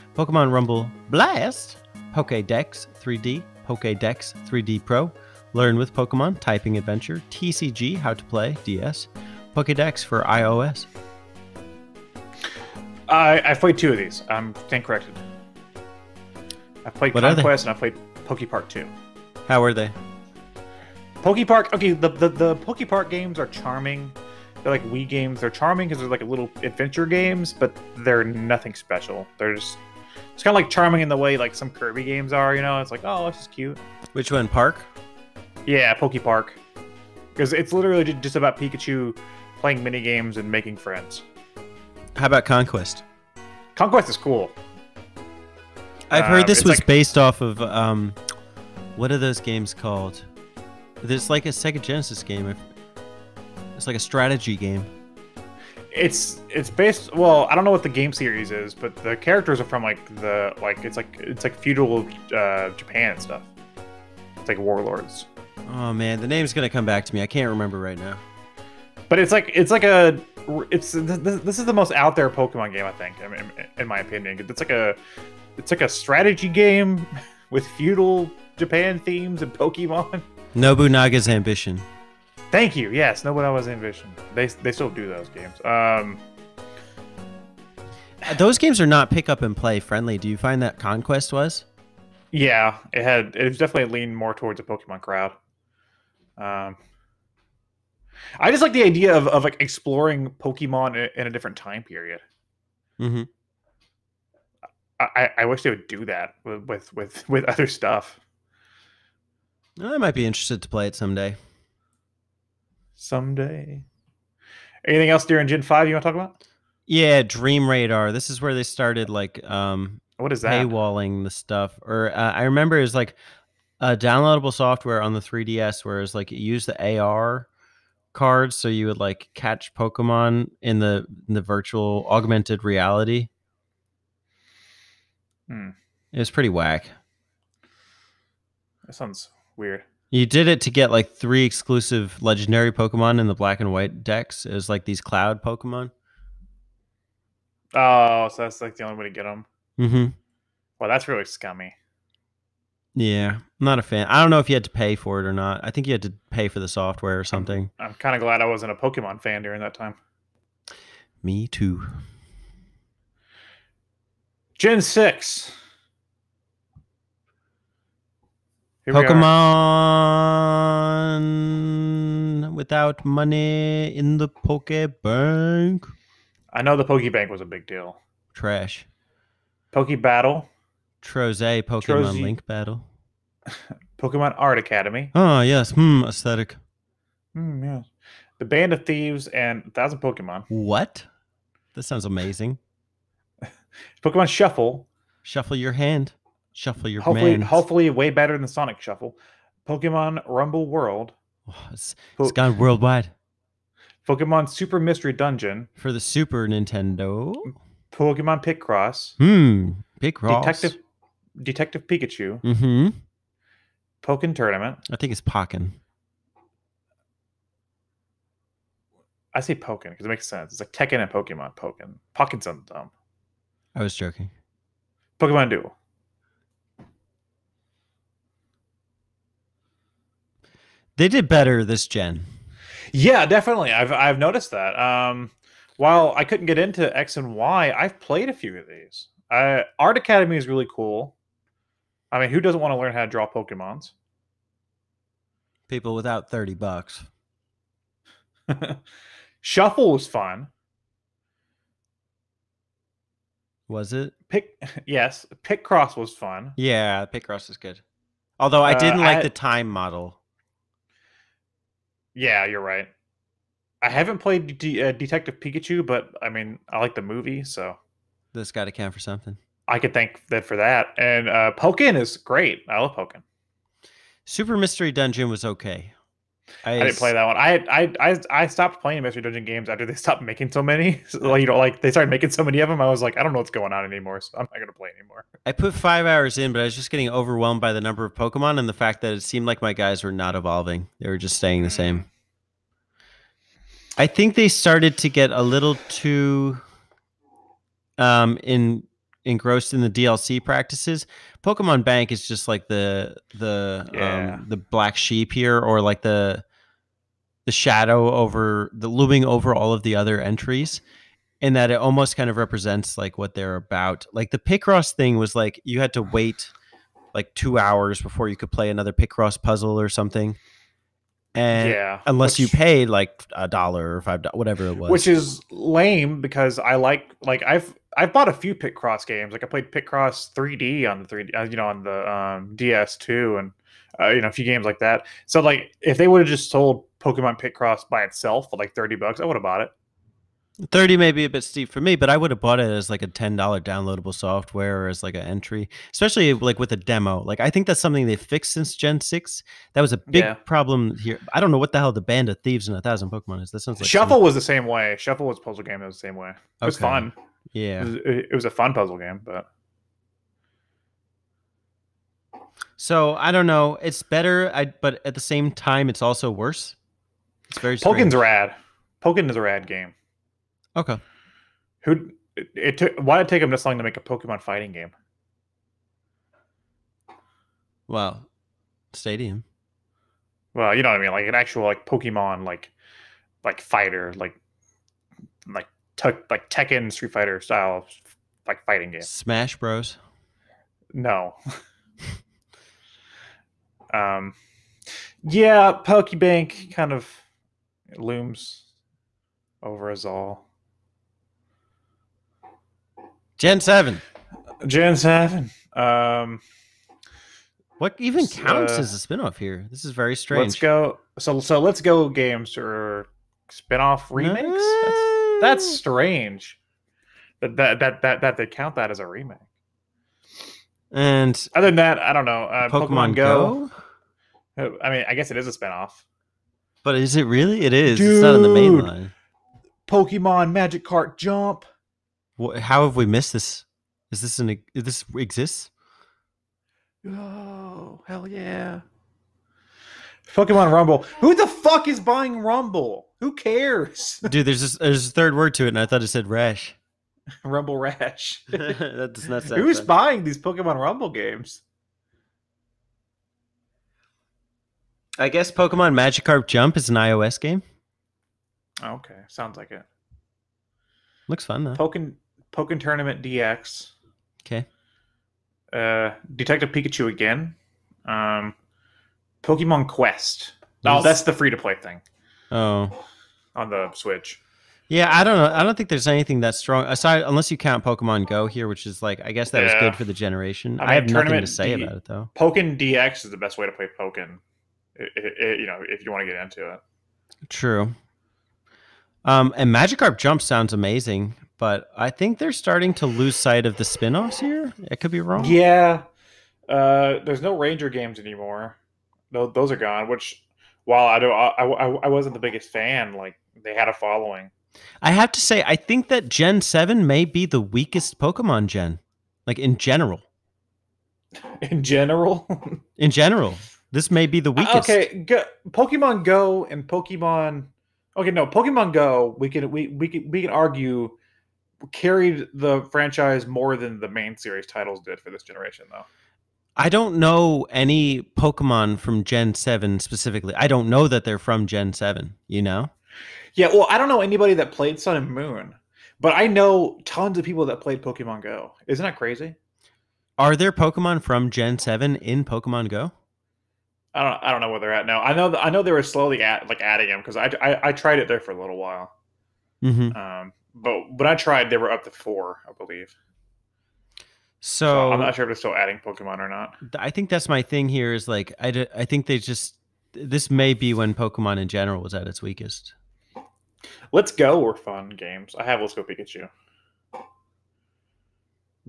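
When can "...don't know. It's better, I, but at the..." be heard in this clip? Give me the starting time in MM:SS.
06:03.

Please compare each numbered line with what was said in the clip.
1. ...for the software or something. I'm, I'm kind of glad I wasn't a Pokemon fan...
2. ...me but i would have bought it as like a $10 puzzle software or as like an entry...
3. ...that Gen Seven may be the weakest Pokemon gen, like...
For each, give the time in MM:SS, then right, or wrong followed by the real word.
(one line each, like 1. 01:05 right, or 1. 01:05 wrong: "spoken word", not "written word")
1. 02:36 right
2. 05:41 wrong: "downloadable", not "puzzle"
3. 08:26 right.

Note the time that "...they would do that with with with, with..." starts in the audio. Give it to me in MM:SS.
01:45.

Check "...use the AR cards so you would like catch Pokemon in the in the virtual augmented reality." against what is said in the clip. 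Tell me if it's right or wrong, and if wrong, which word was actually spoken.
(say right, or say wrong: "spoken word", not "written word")
right.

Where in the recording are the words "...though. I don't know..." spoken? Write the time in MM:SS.
08:45.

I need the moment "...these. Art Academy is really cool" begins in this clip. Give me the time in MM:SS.
03:58.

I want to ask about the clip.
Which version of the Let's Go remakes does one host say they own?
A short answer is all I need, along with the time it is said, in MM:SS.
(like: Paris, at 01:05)
Let's Go Pikachu, at 09:25.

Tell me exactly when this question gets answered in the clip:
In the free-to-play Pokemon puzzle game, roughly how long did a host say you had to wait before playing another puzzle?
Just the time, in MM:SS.
05:17.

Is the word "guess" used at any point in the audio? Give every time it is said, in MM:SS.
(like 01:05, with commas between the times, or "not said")
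07:05, 07:35, 07:59.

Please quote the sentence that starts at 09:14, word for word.
So, so, I'm not sure if it's still adding Pokemon or not.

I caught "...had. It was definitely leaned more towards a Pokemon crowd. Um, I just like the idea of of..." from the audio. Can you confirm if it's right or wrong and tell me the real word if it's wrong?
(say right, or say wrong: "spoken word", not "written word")
right.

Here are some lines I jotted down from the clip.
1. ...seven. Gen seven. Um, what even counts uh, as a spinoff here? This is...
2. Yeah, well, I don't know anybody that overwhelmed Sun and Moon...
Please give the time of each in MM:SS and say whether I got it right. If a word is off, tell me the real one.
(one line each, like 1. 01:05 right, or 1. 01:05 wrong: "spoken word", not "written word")
1. 06:43 right
2. 08:53 wrong: "played", not "overwhelmed".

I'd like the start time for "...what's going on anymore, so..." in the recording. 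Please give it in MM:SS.
04:43.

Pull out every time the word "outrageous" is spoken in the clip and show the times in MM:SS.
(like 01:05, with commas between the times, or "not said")
not said.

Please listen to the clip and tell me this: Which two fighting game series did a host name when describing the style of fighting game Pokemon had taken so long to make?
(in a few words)
Tekken, Street Fighter.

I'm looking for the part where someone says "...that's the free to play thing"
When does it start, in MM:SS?
07:51.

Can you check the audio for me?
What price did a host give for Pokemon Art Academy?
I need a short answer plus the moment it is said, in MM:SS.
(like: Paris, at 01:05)
$30, at 04:06.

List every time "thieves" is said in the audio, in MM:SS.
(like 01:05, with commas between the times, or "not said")
03:08, 05:52.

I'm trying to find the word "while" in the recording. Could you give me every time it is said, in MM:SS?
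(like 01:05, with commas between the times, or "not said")
03:55, 08:20, 09:08.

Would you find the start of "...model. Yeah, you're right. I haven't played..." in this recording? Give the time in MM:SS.
04:19.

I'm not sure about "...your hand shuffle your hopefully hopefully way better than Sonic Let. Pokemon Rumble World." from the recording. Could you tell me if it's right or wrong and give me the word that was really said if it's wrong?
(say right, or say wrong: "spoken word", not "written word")
wrong: "Shuffle", not "Let".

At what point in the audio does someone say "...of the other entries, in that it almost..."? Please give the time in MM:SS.
05:09.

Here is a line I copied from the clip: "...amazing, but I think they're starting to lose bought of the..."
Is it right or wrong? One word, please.
wrong.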